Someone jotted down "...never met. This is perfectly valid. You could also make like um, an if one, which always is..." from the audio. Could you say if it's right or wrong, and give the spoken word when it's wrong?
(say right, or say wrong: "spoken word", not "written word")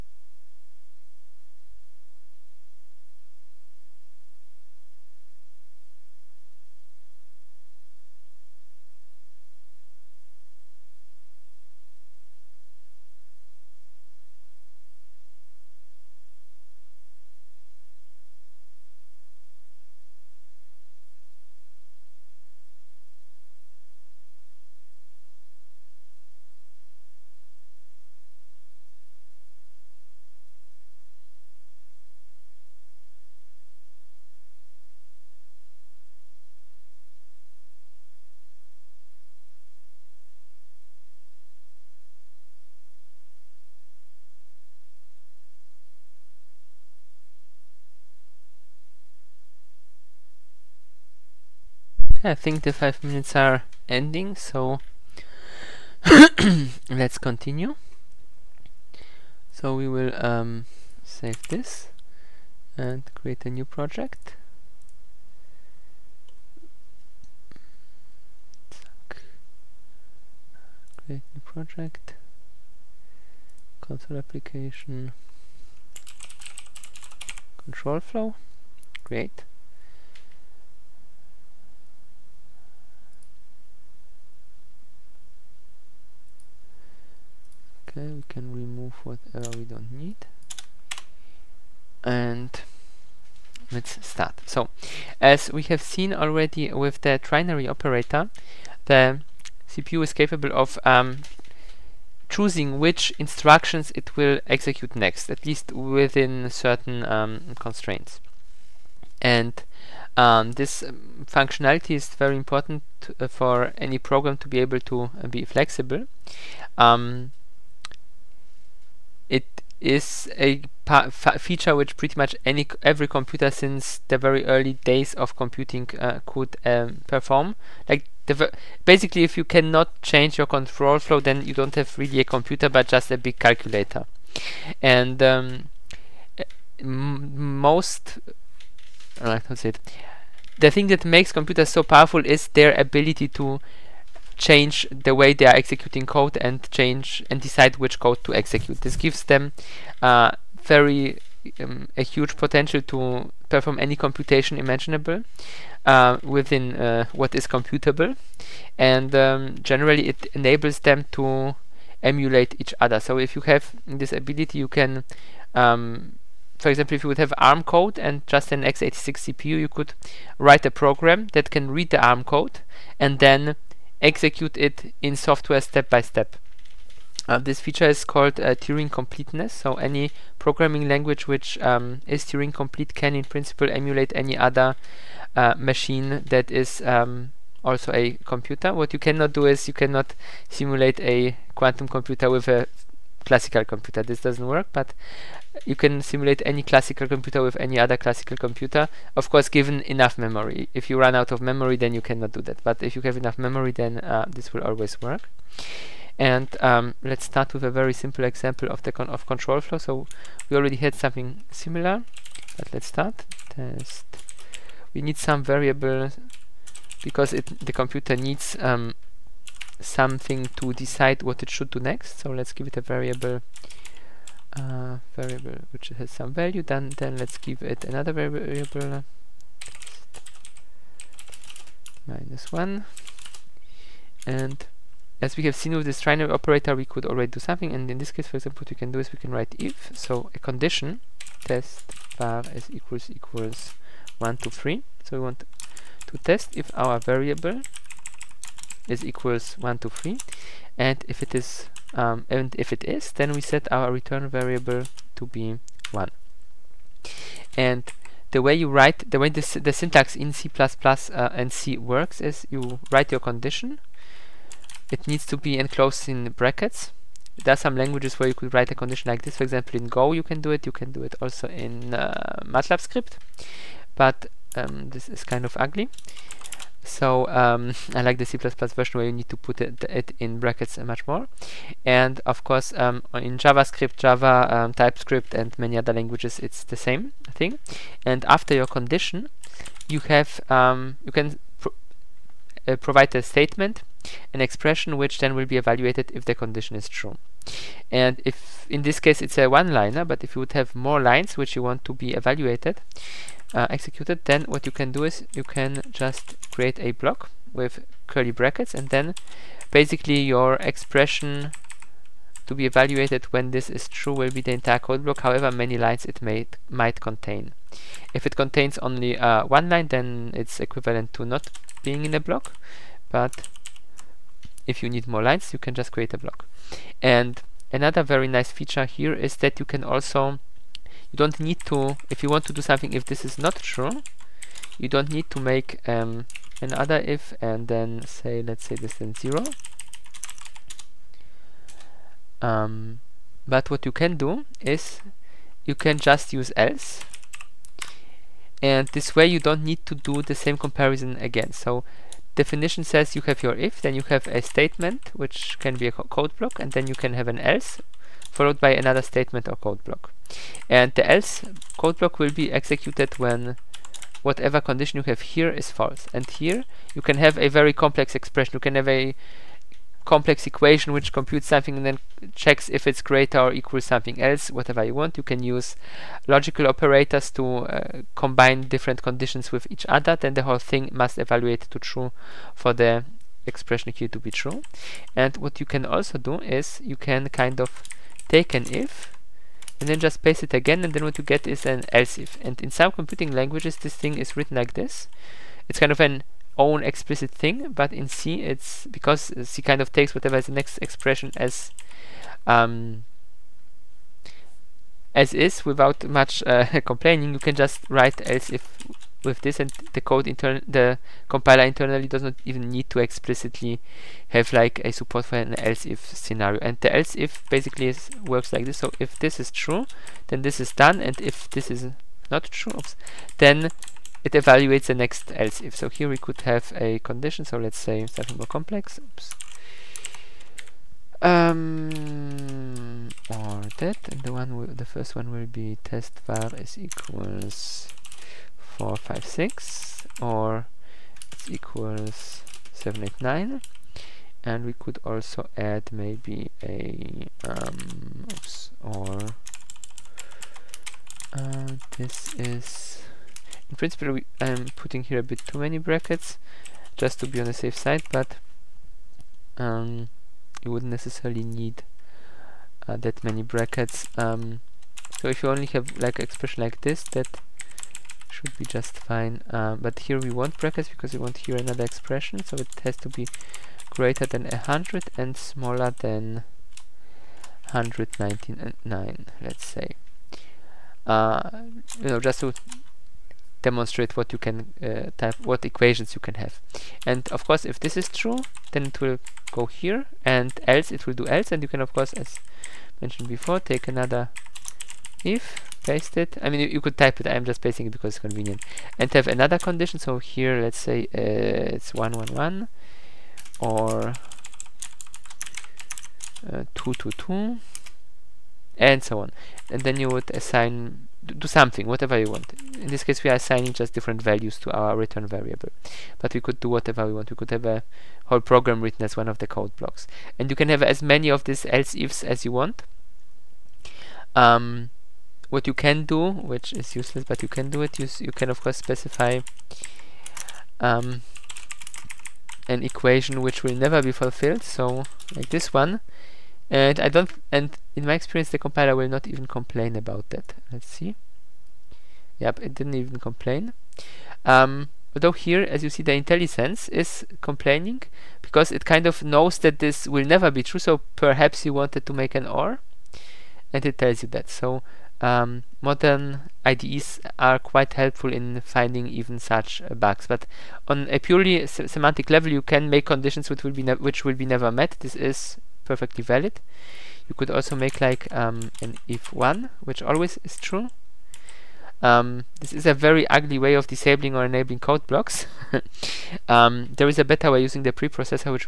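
right.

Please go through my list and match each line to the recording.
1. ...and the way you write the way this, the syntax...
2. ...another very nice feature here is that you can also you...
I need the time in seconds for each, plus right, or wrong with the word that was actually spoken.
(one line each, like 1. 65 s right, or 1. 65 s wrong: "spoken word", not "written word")
1. 257 s right
2. 327 s right.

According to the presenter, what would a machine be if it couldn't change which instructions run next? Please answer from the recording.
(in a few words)
a big calculator.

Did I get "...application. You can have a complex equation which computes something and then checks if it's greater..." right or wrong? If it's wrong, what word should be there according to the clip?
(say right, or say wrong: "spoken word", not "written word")
wrong: "expression", not "application".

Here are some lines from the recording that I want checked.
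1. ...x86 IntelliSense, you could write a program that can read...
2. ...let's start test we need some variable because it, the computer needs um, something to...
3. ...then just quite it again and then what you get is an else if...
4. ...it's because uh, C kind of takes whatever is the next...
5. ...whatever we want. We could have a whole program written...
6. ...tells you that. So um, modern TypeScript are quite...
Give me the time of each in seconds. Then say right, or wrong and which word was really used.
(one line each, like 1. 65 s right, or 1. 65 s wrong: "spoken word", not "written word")
1. 168 s wrong: "CPU", not "IntelliSense"
2. 212 s right
3. 389 s wrong: "paste", not "quite"
4. 398 s right
5. 516 s right
6. 553 s wrong: "IDEs", not "TypeScript".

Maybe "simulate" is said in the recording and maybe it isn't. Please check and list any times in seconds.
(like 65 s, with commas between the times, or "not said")
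190 s, 196 s.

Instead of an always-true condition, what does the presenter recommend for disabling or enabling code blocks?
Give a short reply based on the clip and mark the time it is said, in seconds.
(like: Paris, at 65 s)
the preprocessor, at 577 s.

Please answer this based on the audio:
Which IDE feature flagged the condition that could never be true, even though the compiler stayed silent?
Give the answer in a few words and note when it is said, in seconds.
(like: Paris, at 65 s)
IntelliSense, at 546 s.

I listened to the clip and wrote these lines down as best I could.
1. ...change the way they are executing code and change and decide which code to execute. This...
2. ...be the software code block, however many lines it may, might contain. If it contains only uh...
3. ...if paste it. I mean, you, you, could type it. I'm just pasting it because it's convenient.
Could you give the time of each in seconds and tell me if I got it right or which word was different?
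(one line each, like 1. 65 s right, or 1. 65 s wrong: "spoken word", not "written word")
1. 144 s right
2. 314 s wrong: "entire", not "software"
3. 495 s right.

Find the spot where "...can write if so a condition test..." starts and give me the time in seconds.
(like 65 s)
239 s.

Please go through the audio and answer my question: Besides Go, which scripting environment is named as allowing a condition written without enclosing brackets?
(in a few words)
MATLAB.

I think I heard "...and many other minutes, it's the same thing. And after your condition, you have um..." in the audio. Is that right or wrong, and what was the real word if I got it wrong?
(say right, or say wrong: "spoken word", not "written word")
wrong: "languages", not "minutes".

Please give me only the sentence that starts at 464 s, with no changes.
Um, so if you only have like expression like this, that should be just fine.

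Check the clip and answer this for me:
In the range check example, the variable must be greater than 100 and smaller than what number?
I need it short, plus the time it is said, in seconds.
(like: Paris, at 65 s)
199, at 477 s.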